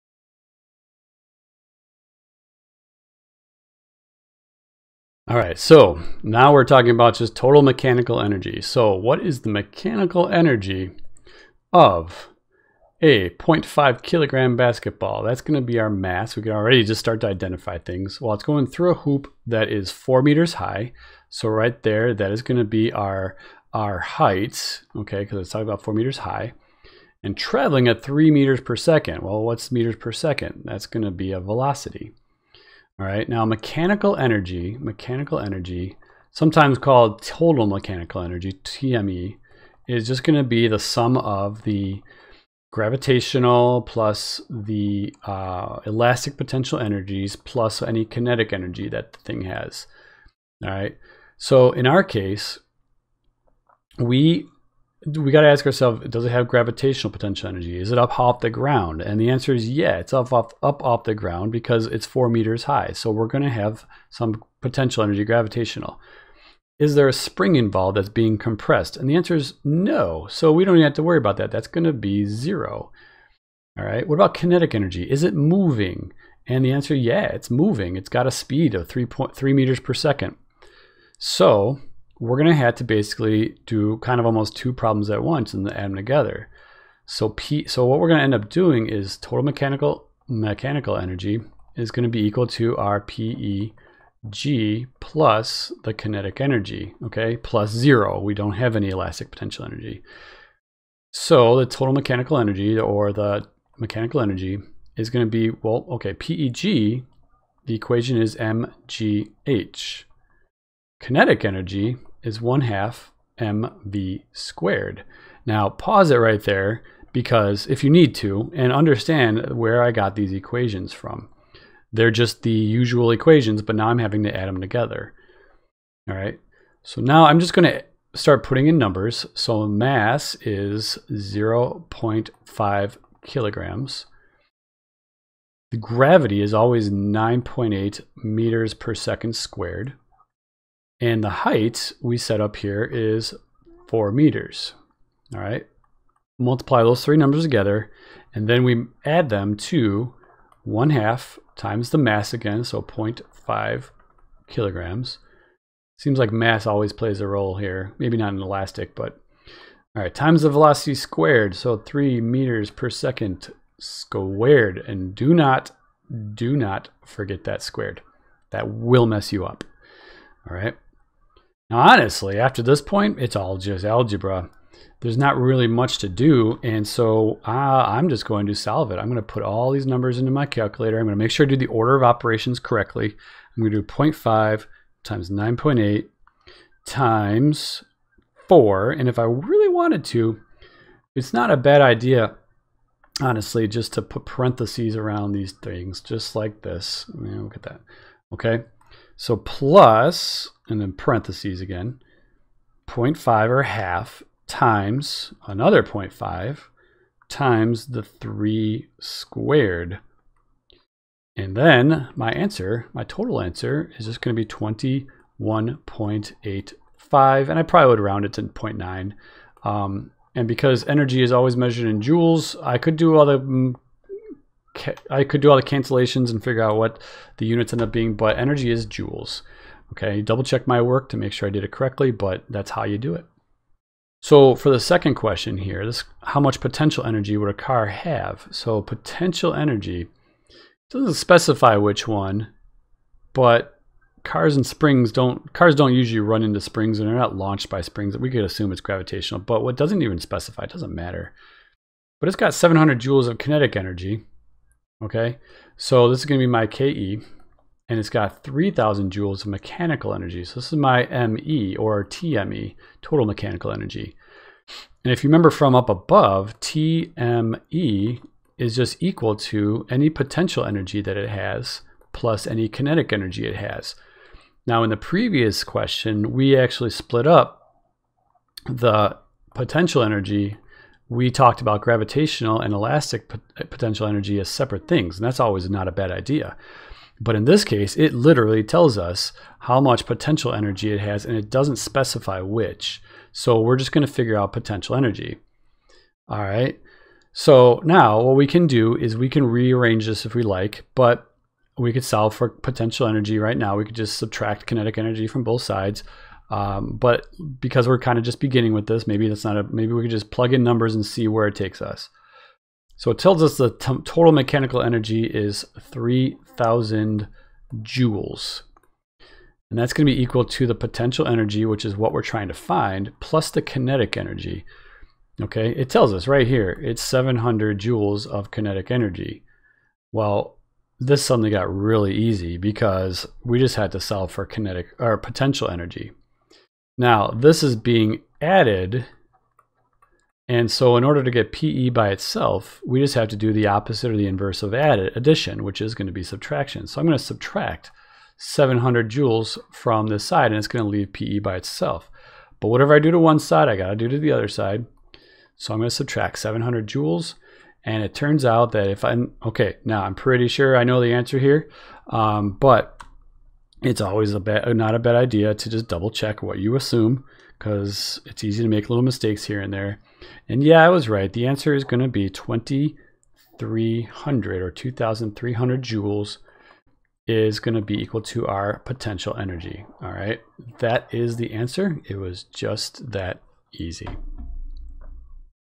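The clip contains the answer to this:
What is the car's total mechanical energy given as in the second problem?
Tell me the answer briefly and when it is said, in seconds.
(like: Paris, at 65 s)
3,000 joules, at 258 s.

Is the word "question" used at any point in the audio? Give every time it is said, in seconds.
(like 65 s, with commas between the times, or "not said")
235 s, 275 s.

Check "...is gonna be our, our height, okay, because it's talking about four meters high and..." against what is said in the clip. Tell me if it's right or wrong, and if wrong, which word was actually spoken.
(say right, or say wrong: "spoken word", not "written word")
right.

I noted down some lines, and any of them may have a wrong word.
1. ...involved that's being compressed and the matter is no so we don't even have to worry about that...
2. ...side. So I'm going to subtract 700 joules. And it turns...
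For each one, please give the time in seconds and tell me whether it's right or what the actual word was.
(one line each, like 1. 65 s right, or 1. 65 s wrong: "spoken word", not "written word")
1. 67 s wrong: "answer", not "matter"
2. 354 s right.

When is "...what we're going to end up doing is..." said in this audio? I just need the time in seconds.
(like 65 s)
87 s.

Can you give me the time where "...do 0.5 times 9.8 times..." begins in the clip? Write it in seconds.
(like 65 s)
183 s.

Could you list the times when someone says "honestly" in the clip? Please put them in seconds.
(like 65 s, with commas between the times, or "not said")
171 s, 193 s.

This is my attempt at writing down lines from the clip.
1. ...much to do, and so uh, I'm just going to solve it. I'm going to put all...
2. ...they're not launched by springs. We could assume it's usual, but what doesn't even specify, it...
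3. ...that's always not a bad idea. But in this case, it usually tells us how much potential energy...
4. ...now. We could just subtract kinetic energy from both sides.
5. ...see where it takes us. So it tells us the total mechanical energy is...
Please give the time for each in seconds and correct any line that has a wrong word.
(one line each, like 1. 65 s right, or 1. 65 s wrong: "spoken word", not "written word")
1. 175 s right
2. 247 s wrong: "gravitational", not "usual"
3. 285 s wrong: "literally", not "usually"
4. 303 s right
5. 311 s right.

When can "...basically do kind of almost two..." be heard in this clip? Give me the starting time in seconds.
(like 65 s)
82 s.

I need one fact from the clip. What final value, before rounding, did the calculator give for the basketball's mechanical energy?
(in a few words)
21.85.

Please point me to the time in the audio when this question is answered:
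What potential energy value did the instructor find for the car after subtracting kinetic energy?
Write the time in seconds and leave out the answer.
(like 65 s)
374 s.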